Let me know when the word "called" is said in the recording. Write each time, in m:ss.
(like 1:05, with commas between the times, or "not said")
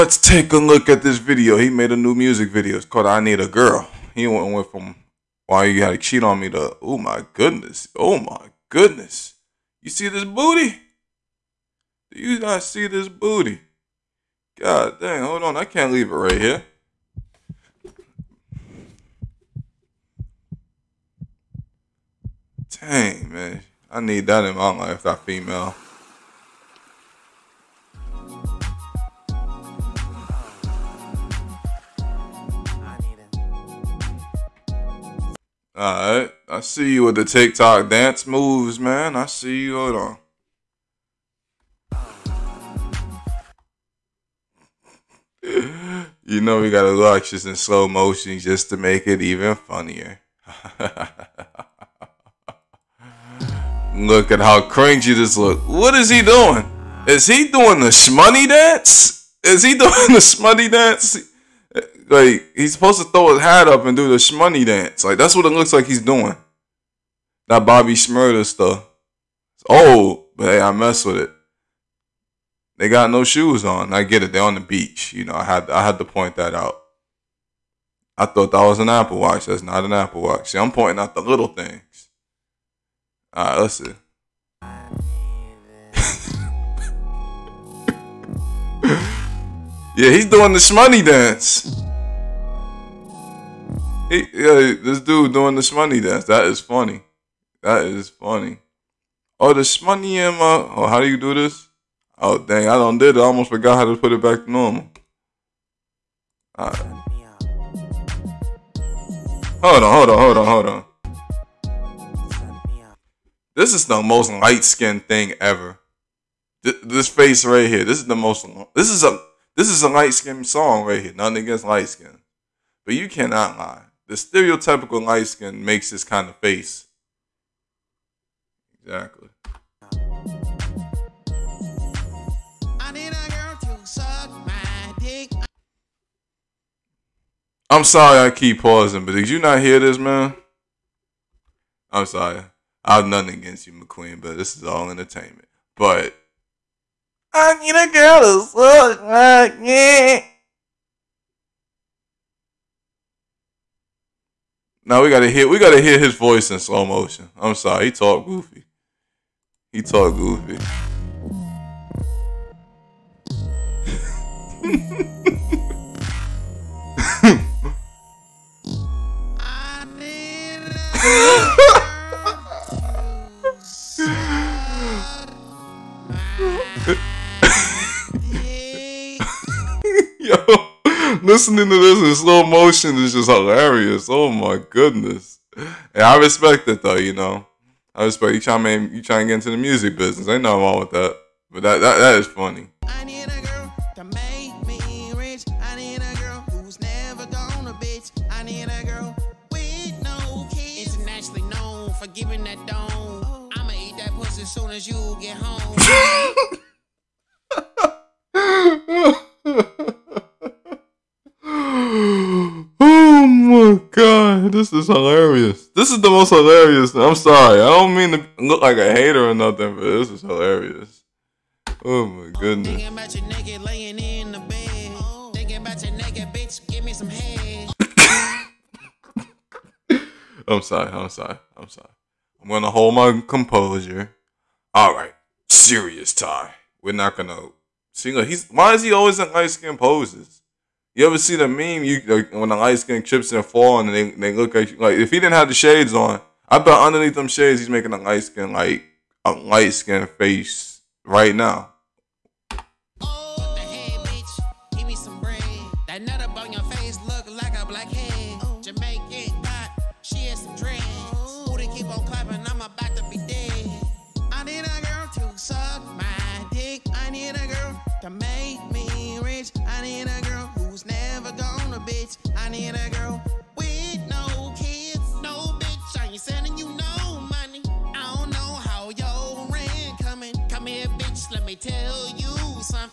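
0:02.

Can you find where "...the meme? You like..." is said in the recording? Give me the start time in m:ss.
4:01.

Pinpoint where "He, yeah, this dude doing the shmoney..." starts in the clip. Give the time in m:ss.
1:34.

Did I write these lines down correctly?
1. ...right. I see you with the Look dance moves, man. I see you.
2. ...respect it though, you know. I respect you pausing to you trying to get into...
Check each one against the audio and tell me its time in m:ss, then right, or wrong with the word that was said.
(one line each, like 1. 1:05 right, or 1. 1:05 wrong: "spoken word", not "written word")
1. 0:36 wrong: "TikTok", not "Look"
2. 3:06 wrong: "trying", not "pausing".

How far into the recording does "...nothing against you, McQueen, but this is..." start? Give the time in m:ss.
2:23.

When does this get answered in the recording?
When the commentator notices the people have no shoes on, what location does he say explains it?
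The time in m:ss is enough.
1:14.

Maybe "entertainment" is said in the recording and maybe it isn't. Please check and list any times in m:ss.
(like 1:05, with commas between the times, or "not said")
2:24.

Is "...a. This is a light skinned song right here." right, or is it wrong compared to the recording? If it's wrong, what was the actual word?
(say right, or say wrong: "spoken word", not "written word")
right.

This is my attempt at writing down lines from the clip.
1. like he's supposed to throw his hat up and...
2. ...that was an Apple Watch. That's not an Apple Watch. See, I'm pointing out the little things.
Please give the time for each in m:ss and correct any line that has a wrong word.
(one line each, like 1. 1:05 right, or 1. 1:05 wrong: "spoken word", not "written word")
1. 1:02 right
2. 1:18 right.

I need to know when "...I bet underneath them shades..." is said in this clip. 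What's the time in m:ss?
4:06.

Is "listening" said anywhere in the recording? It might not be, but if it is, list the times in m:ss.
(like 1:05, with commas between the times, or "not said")
3:01.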